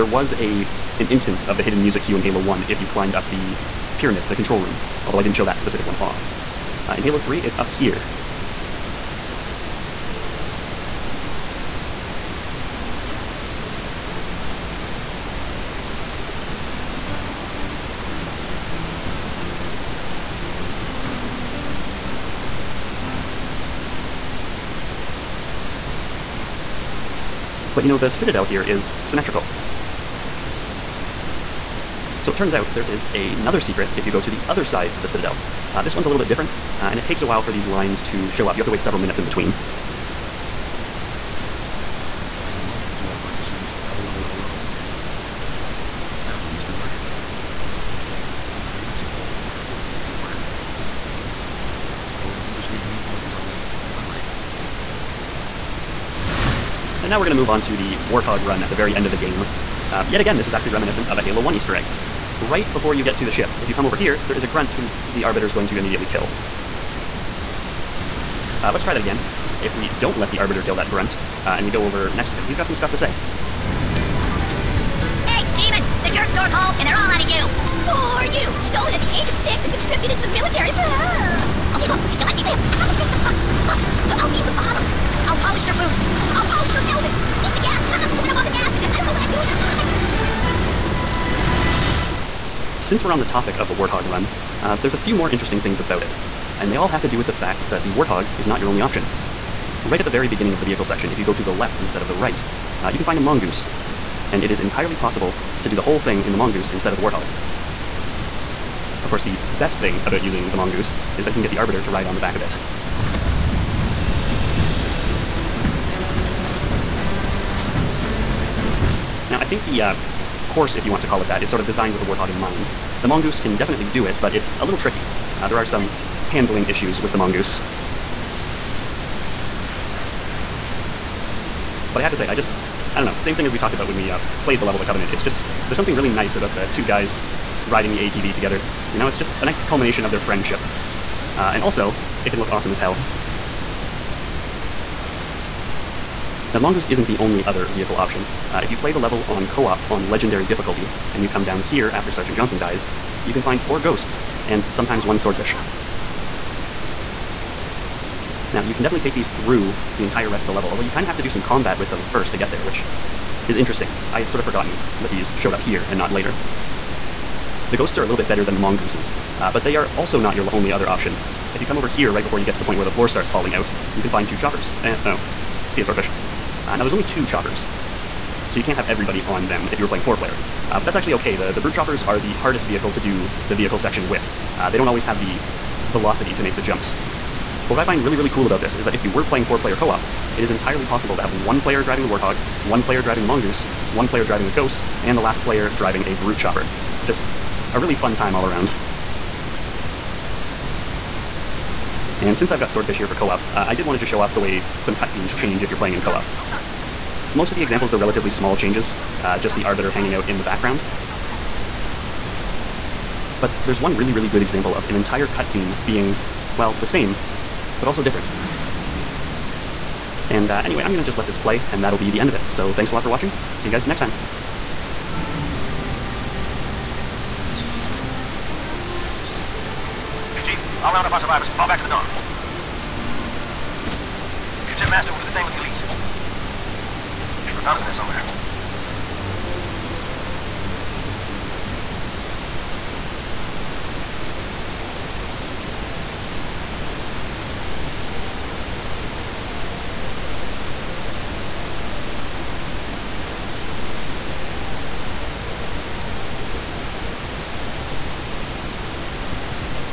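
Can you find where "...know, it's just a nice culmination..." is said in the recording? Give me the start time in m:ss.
2:18.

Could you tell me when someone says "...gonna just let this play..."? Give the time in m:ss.
3:40.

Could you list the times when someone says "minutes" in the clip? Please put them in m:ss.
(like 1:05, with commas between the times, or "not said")
0:38.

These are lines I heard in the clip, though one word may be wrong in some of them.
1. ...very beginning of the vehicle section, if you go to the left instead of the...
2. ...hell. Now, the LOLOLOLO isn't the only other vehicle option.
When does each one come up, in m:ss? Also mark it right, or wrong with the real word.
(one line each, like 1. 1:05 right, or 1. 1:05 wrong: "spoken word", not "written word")
1. 1:40 right
2. 2:22 wrong: "Mongoose", not "LOLOLOLO".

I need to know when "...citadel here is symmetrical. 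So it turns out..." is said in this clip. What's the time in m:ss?
0:28.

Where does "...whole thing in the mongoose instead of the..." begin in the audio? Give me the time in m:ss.
1:45.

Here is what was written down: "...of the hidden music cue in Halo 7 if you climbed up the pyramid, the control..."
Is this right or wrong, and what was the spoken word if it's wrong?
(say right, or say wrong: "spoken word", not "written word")
wrong: "1", not "7".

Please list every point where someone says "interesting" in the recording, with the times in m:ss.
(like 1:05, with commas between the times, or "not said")
1:35, 2:43.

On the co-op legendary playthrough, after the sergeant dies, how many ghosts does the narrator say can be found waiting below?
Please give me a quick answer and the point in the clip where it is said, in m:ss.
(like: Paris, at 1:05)
4, at 2:33.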